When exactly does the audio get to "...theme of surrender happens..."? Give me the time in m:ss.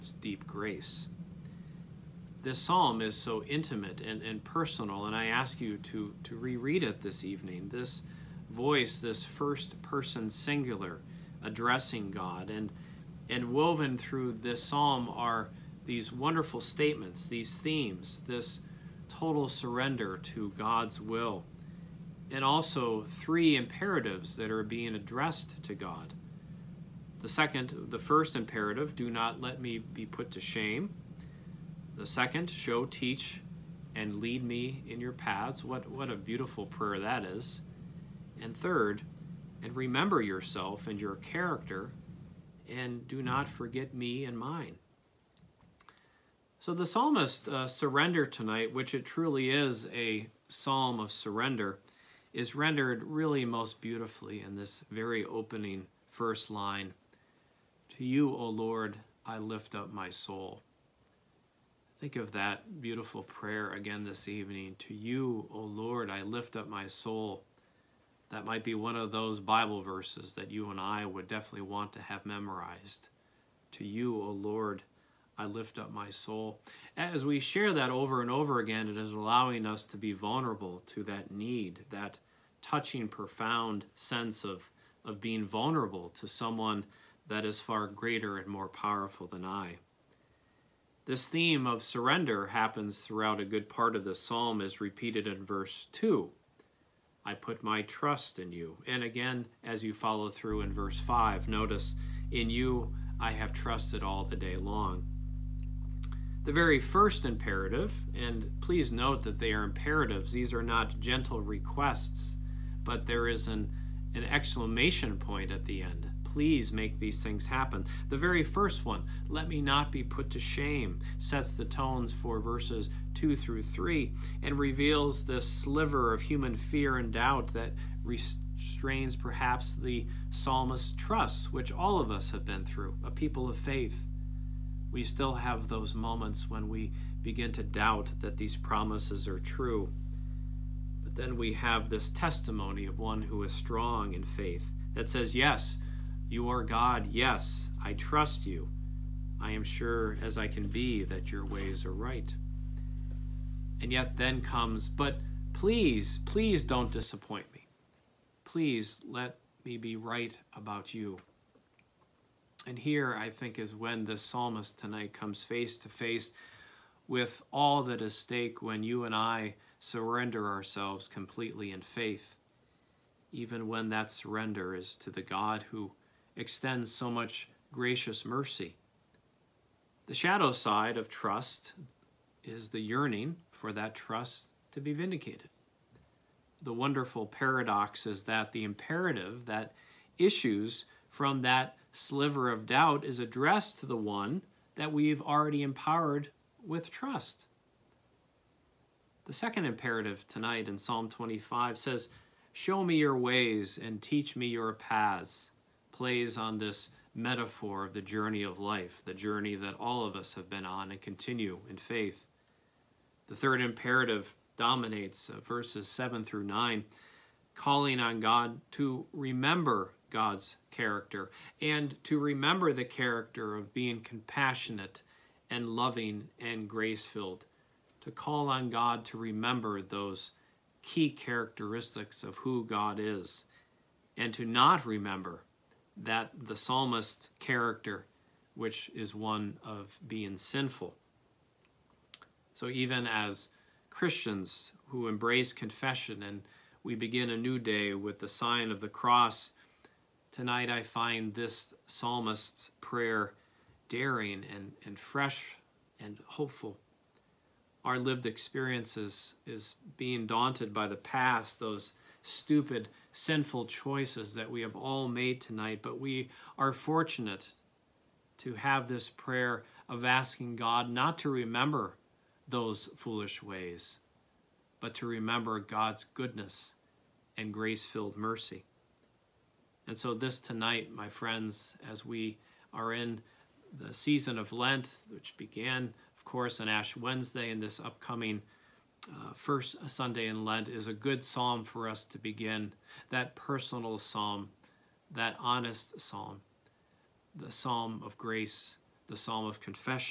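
1:31.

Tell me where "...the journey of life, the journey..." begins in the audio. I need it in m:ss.
3:27.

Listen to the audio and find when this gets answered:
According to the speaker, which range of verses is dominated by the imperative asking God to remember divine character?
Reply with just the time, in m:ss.
3:35.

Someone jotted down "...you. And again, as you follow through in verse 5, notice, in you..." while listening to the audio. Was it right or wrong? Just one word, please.
right.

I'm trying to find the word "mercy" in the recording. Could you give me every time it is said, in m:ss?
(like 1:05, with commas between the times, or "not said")
2:58, 4:38.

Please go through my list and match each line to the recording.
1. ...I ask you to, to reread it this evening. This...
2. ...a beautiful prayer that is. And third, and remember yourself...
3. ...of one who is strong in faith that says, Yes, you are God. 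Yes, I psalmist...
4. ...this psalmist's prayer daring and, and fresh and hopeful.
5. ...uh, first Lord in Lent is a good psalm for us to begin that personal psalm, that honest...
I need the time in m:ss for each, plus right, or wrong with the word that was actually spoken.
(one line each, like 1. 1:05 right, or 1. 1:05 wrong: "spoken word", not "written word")
1. 0:05 right
2. 0:36 right
3. 2:22 wrong: "trust", not "psalmist"
4. 4:11 right
5. 4:49 wrong: "Sunday", not "Lord".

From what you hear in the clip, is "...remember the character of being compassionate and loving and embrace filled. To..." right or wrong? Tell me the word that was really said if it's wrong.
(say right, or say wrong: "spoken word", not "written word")
wrong: "grace", not "embrace".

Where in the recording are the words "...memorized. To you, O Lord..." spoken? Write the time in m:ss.
1:12.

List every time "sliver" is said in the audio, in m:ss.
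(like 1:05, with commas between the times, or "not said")
2:05, 3:11.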